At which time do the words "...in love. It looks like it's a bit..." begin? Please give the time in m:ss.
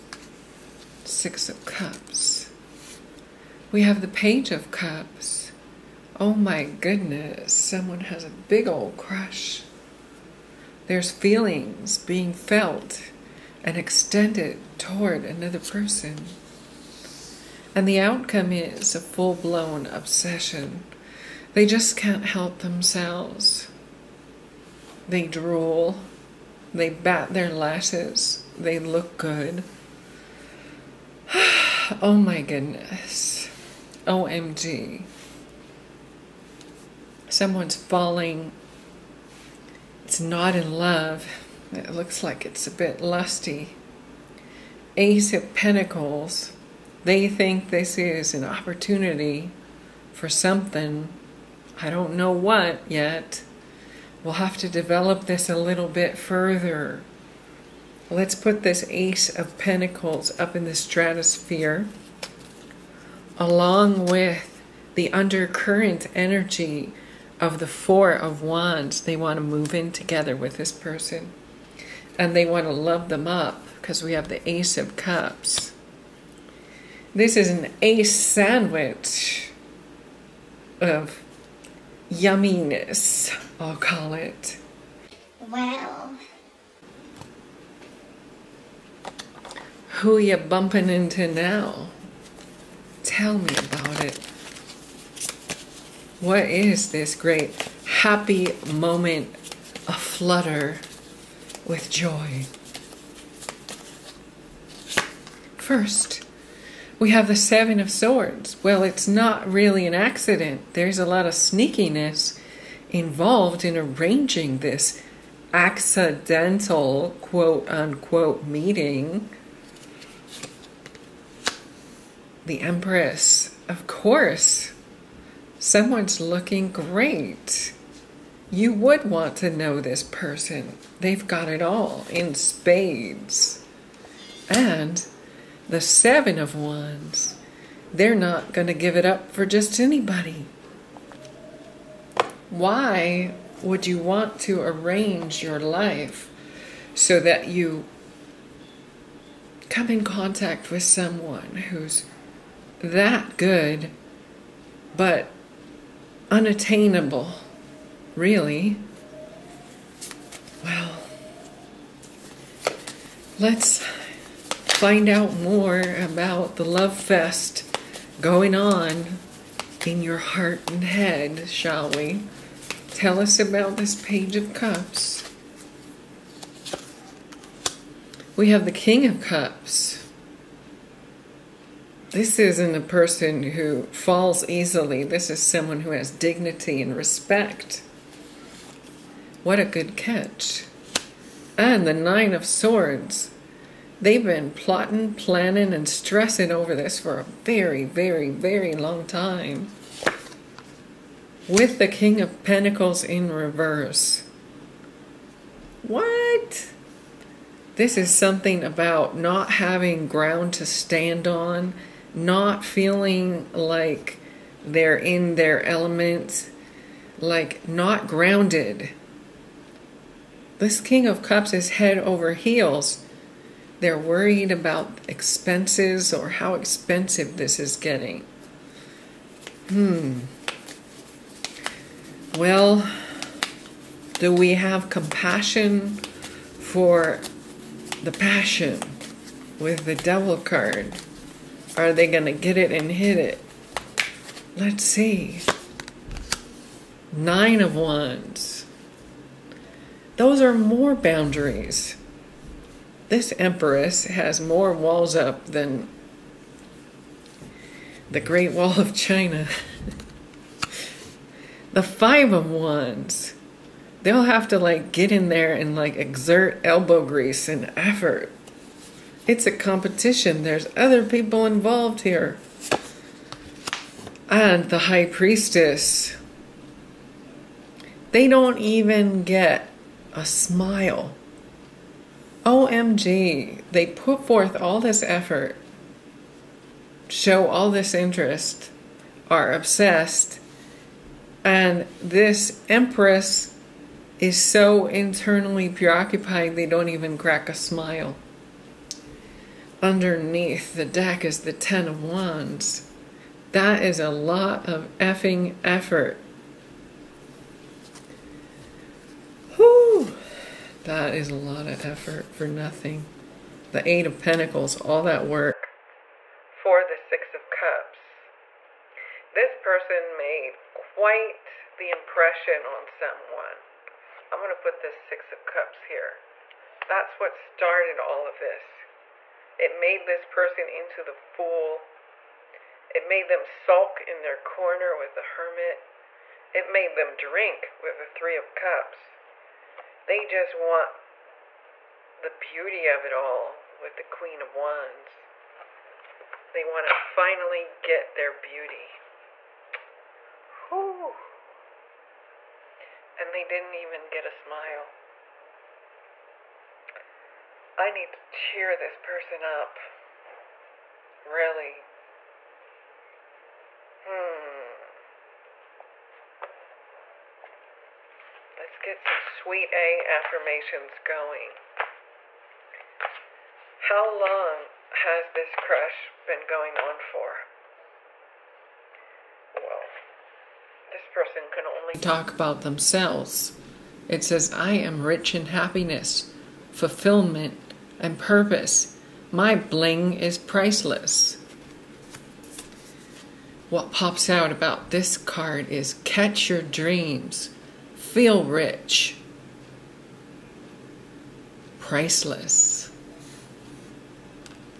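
0:40.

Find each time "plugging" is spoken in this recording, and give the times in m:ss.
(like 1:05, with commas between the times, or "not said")
not said.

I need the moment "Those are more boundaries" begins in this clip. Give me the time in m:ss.
4:10.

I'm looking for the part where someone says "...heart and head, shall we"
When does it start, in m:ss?
2:50.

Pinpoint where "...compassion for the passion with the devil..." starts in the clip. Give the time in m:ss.
3:54.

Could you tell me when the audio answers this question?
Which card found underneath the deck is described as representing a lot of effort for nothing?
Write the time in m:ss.
5:01.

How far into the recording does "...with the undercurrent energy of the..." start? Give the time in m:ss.
1:04.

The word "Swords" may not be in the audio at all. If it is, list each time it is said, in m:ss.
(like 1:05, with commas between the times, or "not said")
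1:47, 3:12.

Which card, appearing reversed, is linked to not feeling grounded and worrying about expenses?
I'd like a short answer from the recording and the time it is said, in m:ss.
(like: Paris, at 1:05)
King of Pentacles, at 3:21.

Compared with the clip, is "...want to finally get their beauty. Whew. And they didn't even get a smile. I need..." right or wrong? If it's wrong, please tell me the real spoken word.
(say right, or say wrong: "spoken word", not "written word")
right.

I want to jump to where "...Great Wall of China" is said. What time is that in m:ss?
4:18.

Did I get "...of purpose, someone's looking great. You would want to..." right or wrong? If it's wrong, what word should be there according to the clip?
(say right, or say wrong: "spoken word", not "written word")
wrong: "course", not "purpose".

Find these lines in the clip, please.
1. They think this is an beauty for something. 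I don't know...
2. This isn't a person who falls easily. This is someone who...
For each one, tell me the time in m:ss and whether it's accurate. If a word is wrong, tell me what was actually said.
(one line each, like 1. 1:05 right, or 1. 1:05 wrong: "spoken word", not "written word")
1. 0:47 wrong: "opportunity", not "beauty"
2. 3:02 right.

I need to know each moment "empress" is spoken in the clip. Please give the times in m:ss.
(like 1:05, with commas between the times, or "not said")
2:02, 4:13, 4:52.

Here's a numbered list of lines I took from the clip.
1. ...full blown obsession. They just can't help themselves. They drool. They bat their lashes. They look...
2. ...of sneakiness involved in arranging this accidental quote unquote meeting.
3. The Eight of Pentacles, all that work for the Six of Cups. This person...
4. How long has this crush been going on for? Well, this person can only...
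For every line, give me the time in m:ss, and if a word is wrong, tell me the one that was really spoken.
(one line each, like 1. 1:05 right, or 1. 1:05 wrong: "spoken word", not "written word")
1. 0:18 right
2. 1:51 right
3. 5:13 right
4. 6:13 right.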